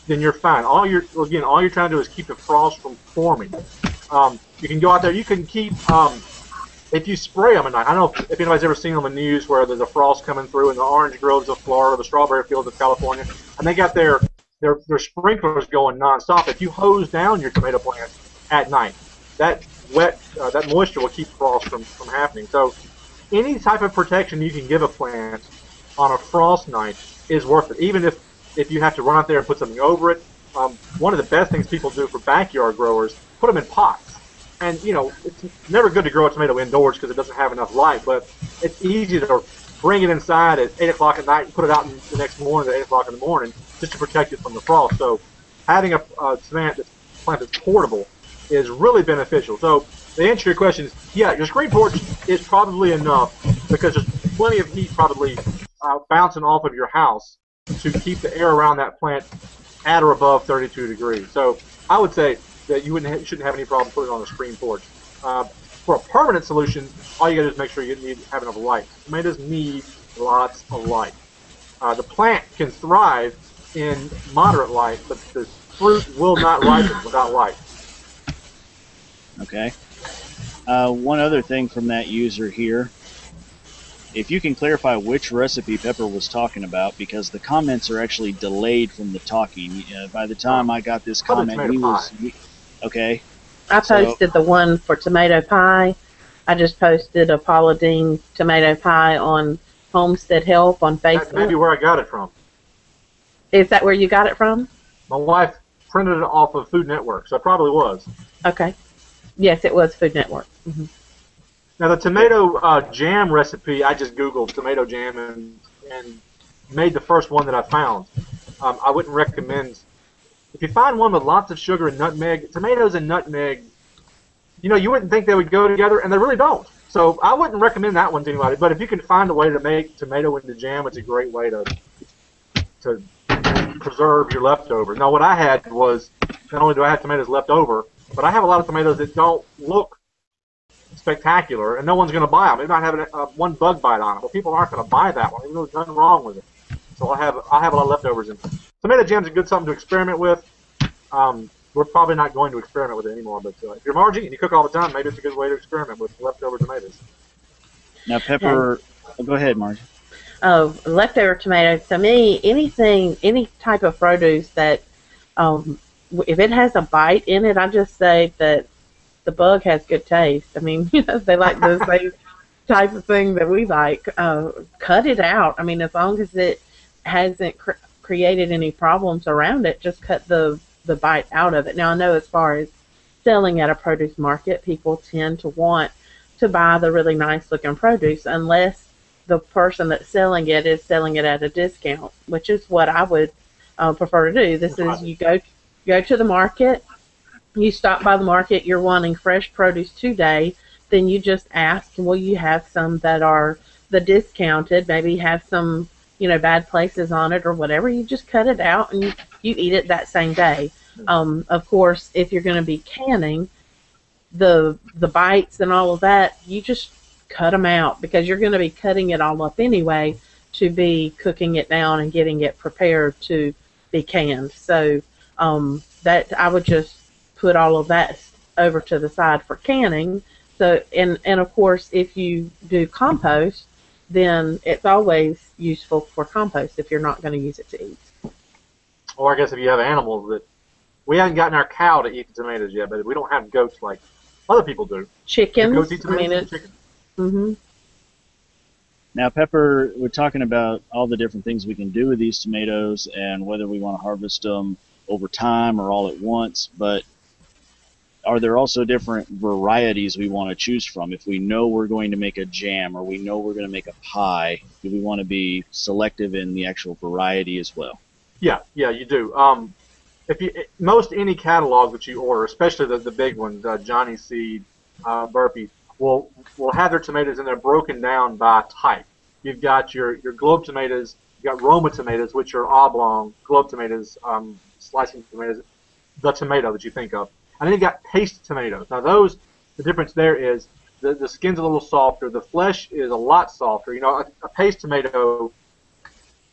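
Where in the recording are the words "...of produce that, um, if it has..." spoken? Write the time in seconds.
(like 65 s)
163 s.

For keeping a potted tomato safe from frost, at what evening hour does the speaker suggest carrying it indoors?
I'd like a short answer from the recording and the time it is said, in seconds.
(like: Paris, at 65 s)
8 o'clock, at 40 s.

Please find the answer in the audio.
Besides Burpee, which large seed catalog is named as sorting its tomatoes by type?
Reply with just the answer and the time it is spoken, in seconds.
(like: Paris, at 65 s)
Johnny Seed, at 273 s.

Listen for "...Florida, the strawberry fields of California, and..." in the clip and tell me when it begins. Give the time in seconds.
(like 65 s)
11 s.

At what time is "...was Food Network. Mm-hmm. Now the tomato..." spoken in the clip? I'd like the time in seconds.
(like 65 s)
109 s.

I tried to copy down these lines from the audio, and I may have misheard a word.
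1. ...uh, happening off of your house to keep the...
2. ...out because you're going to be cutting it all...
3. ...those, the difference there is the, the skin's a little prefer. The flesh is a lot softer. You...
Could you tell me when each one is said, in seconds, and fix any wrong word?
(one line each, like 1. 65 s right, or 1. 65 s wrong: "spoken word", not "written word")
1. 55 s wrong: "bouncing", not "happening"
2. 217 s right
3. 289 s wrong: "softer", not "prefer".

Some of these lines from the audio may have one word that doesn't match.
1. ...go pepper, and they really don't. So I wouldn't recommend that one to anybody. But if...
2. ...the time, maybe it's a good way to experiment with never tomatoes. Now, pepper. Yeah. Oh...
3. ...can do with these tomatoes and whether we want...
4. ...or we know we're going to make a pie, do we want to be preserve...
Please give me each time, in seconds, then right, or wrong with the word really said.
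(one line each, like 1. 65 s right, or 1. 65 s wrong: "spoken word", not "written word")
1. 125 s wrong: "together", not "pepper"
2. 154 s wrong: "leftover", not "never"
3. 251 s right
4. 262 s wrong: "selective", not "preserve".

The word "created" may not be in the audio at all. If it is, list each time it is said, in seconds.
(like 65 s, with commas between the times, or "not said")
178 s.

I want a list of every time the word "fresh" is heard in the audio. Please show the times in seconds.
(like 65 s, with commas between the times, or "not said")
199 s.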